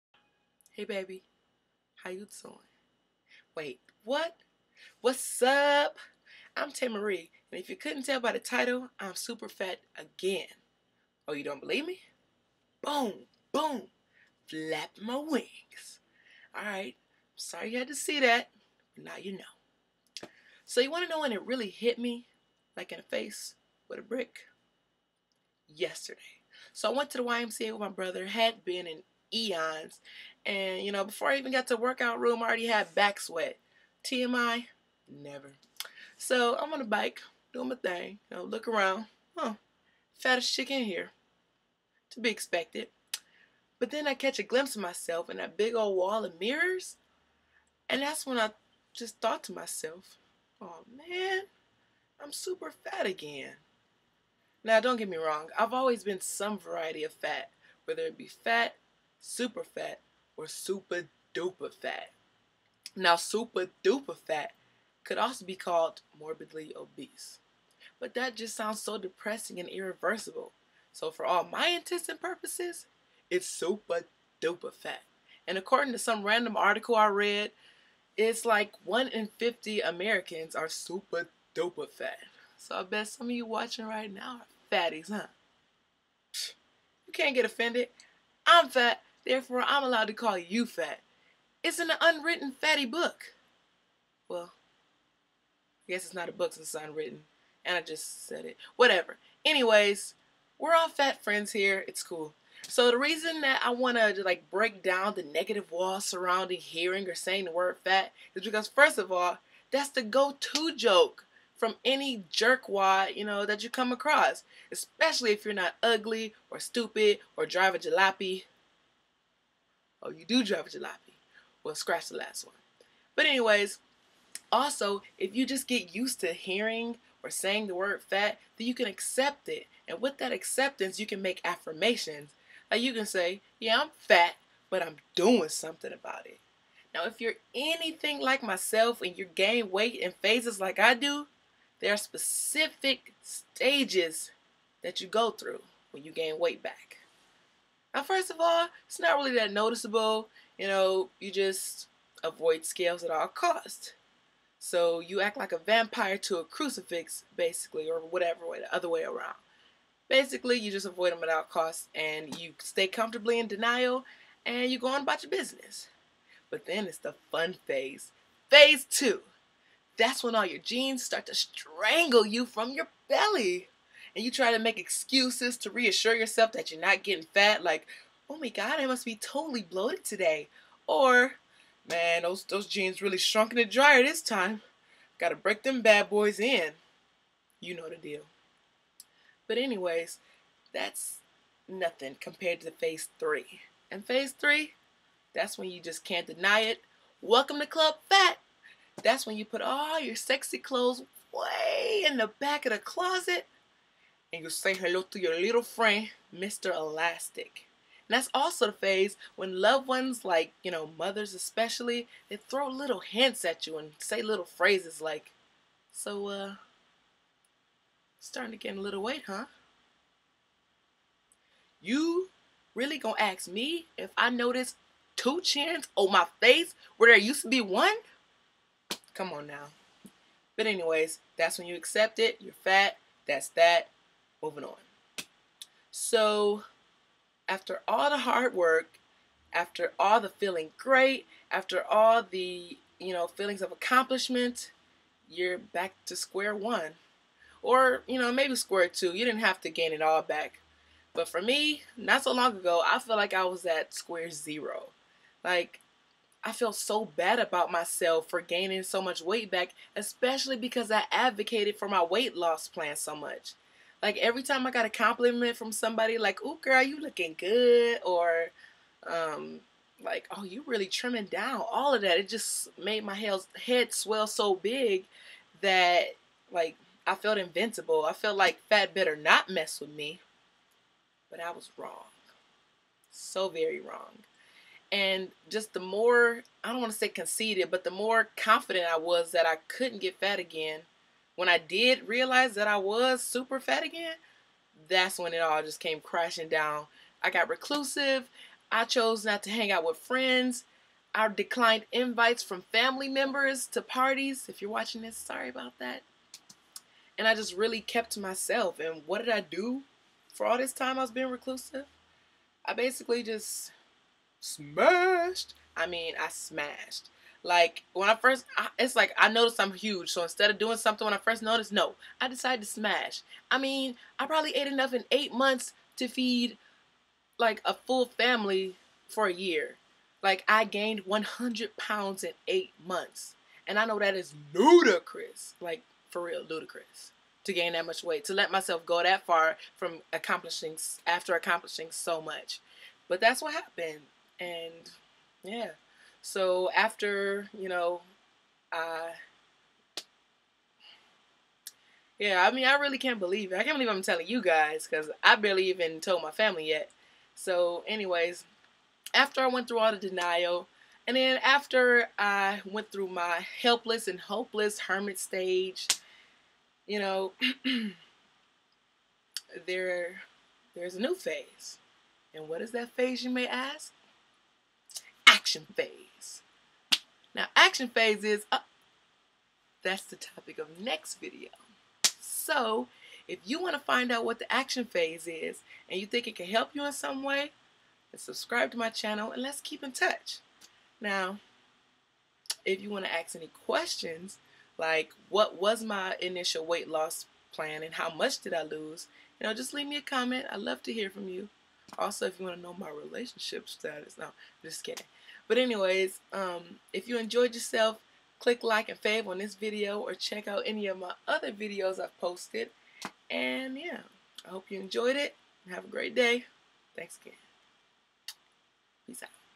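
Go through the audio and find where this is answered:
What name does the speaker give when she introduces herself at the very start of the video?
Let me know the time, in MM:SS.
00:06.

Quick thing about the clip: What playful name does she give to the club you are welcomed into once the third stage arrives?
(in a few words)
Club Fat.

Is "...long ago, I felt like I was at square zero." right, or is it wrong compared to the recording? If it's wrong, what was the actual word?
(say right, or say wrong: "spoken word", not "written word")
right.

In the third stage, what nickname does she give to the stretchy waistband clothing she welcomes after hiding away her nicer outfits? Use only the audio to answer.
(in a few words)
Mr. Elastic.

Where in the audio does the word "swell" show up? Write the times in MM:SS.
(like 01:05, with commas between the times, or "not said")
04:33.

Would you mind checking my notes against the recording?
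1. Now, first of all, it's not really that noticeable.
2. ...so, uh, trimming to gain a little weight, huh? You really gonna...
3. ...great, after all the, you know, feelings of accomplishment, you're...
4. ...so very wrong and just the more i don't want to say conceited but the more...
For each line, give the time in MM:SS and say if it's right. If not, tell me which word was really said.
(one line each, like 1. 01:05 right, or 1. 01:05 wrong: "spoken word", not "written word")
1. 02:27 right
2. 03:35 wrong: "starting", not "trimming"
3. 04:00 right
4. 04:43 right.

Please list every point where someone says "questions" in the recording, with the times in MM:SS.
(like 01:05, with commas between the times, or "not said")
06:33.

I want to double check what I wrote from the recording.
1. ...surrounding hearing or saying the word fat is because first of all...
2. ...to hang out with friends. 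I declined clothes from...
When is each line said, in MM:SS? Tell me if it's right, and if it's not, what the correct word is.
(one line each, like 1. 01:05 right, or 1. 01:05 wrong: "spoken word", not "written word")
1. 01:46 right
2. 04:59 wrong: "invites", not "clothes".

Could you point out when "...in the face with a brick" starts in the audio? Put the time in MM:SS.
00:22.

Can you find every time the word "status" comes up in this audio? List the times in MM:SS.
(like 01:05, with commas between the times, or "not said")
06:43.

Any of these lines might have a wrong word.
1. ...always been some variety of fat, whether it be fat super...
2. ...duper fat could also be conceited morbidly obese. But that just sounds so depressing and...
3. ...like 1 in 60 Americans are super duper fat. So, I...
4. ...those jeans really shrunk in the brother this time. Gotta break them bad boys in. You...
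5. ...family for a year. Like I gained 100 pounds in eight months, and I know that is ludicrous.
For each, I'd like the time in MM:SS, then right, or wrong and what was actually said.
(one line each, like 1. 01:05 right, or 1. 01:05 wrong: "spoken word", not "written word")
1. 00:55 right
2. 01:03 wrong: "called", not "conceited"
3. 01:18 wrong: "50", not "60"
4. 03:02 wrong: "dryer", not "brother"
5. 05:28 right.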